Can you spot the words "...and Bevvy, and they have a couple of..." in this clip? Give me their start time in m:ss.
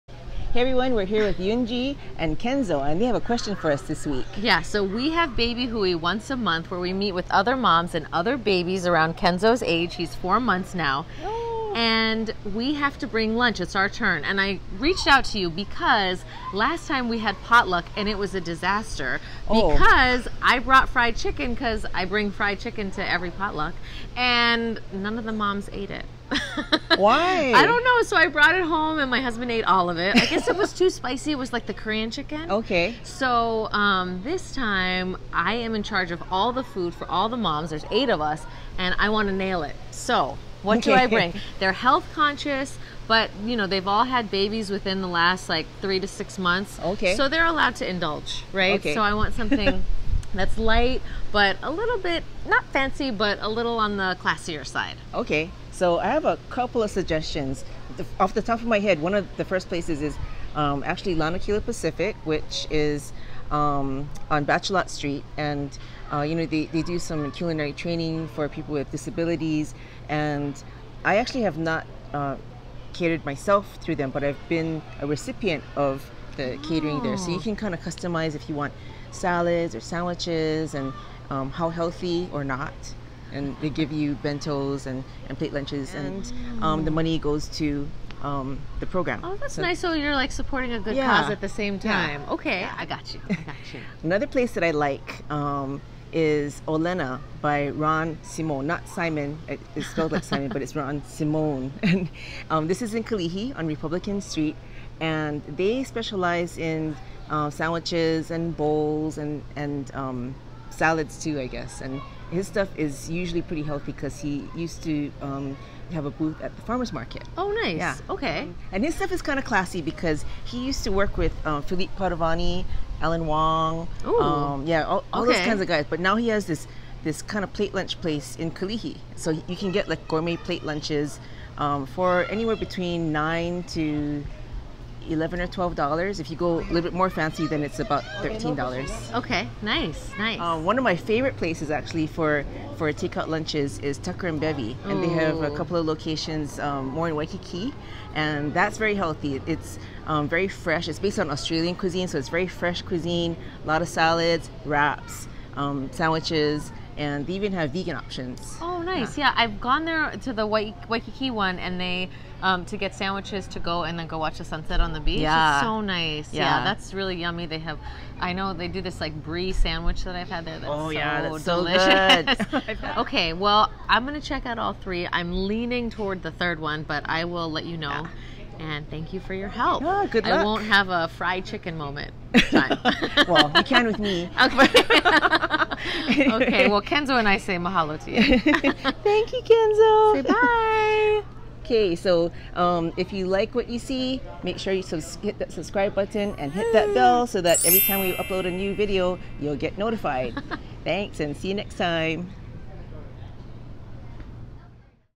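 2:24.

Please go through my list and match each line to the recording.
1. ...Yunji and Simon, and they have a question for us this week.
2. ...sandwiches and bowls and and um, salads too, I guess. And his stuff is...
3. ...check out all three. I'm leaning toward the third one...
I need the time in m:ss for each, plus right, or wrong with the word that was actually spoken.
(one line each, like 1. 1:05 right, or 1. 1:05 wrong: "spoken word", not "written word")
1. 0:01 wrong: "Kenzo", not "Simon"
2. 1:47 right
3. 2:54 right.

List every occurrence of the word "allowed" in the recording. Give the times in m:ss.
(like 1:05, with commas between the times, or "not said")
0:47.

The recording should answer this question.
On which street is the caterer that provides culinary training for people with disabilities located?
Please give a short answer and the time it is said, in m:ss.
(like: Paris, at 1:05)
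Bachelot Street, at 1:04.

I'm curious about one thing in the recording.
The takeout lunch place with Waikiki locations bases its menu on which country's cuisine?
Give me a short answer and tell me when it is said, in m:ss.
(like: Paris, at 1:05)
Australian, at 2:31.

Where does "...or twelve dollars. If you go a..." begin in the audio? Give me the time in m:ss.
2:15.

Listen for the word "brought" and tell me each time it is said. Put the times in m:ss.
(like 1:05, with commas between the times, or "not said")
0:20, 0:28.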